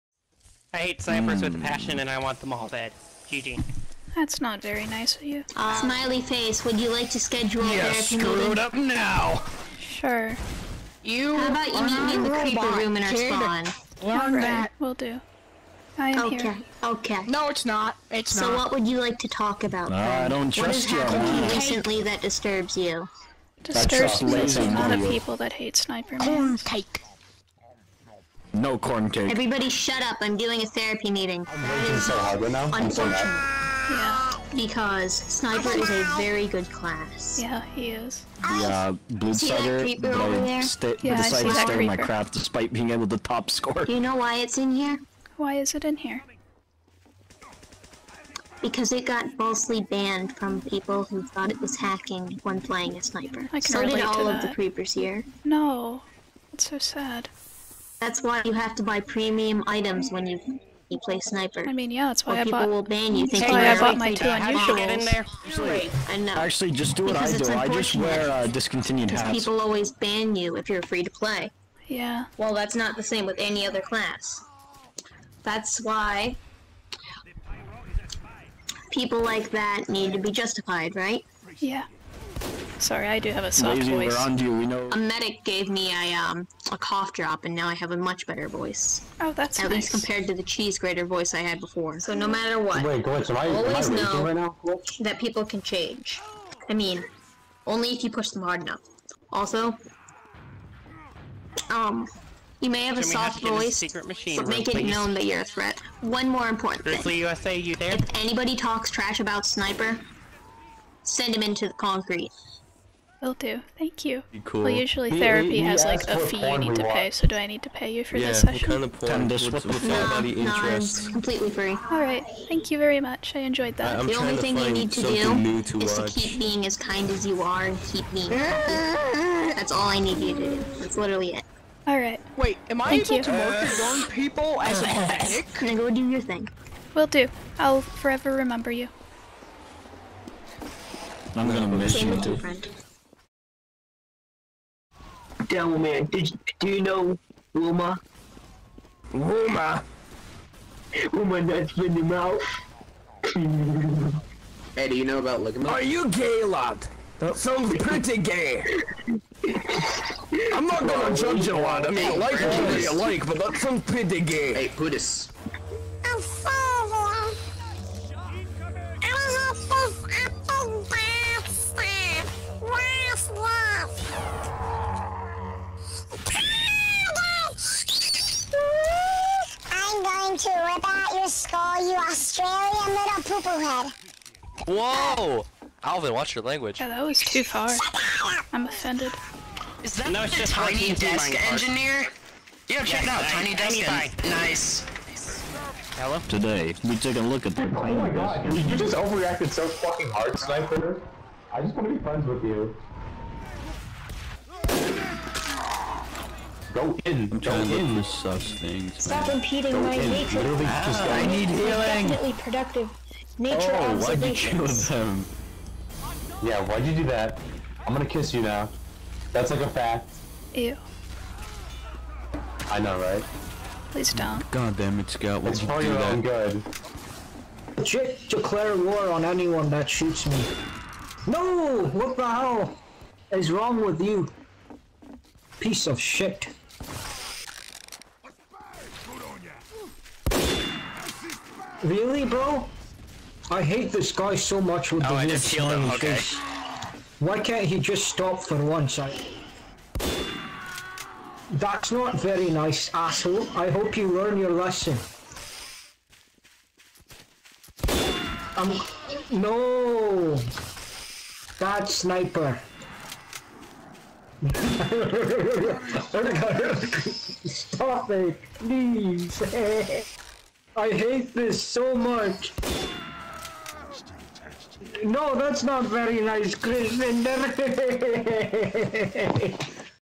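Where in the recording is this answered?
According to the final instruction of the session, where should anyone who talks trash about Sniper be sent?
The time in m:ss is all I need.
1:51.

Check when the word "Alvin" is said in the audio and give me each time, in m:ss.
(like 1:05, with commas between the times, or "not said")
3:05.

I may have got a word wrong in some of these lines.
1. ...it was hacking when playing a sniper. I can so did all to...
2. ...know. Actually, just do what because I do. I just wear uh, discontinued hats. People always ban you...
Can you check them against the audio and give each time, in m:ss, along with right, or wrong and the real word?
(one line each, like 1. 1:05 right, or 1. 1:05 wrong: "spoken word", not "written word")
1. 0:51 right
2. 1:06 right.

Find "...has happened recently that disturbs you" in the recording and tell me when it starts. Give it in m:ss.
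0:21.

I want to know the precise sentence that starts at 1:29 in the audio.
least compared to the cheese grater voice I had before.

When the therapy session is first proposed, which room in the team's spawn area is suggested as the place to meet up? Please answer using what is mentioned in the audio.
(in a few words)
the creeper room.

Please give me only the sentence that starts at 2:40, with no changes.
I'm not gonna well, judge you, lad.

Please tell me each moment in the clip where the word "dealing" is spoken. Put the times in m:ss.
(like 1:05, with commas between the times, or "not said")
not said.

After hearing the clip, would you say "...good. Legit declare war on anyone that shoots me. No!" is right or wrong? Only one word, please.
right.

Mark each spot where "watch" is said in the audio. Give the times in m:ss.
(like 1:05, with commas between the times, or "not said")
2:05, 3:06.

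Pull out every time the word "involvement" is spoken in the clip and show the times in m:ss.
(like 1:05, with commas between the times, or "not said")
not said.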